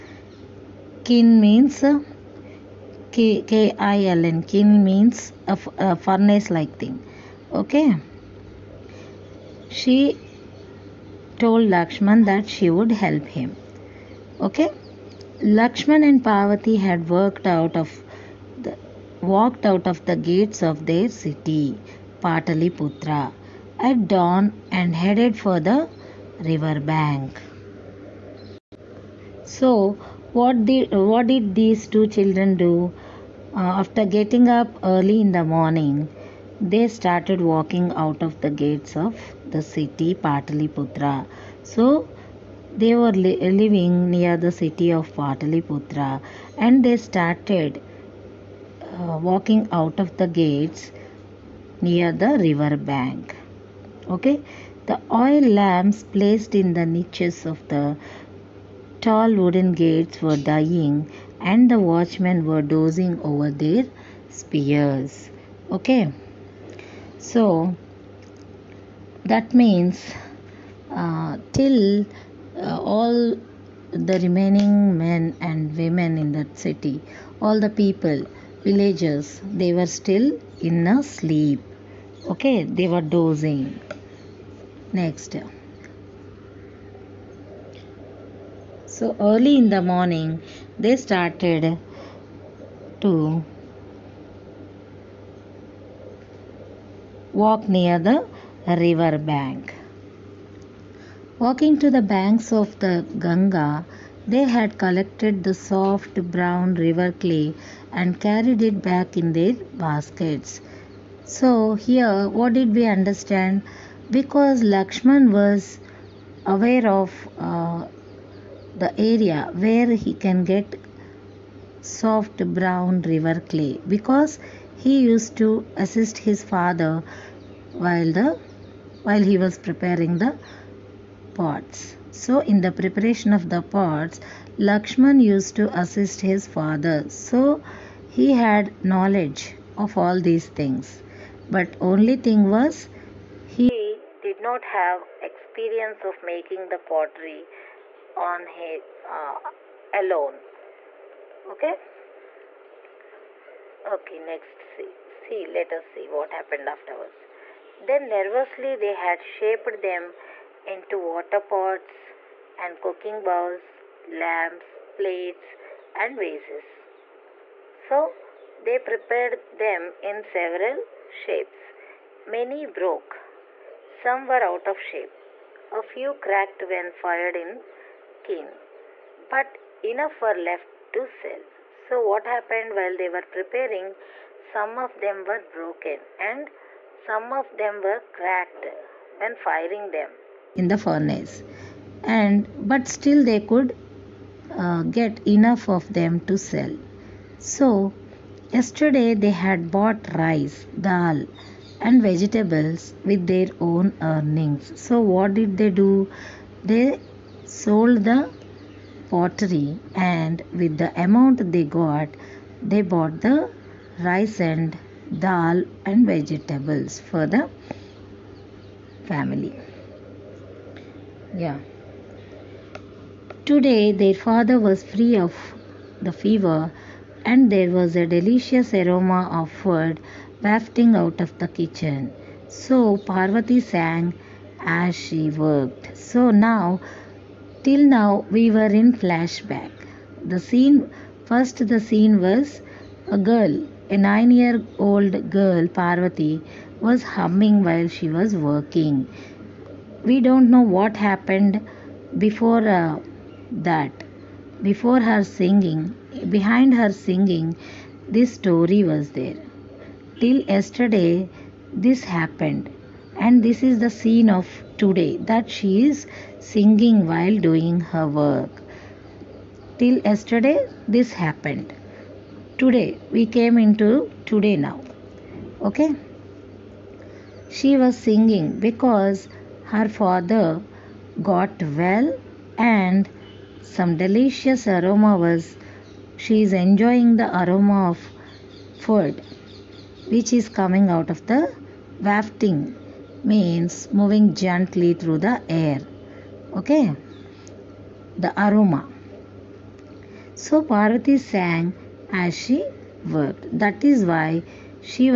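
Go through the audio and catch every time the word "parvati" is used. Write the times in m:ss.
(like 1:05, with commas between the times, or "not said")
0:16, 3:52, 4:05, 5:00.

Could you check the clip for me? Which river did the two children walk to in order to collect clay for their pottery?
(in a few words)
Ganga.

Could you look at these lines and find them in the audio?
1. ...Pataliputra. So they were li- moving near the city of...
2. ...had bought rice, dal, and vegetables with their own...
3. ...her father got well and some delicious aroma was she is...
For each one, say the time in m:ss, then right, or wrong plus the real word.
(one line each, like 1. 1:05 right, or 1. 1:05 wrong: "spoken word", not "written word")
1. 0:40 wrong: "living", not "moving"
2. 3:19 right
3. 4:39 right.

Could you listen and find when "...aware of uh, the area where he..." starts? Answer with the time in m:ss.
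1:56.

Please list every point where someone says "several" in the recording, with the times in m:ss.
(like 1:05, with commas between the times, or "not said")
2:50.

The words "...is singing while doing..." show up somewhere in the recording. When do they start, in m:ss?
4:25.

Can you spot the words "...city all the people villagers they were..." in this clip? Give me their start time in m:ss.
1:16.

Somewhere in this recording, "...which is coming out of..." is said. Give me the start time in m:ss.
4:50.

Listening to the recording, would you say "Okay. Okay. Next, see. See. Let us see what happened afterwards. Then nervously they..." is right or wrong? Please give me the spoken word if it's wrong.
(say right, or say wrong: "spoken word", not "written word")
right.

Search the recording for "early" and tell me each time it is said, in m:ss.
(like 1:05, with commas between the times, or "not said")
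0:34, 1:29.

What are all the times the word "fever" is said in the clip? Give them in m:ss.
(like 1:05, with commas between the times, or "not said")
3:46.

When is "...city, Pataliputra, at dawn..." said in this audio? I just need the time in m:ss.
0:21.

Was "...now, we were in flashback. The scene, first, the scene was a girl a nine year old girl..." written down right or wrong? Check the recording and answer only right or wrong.
right.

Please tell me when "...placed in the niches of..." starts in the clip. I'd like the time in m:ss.
0:56.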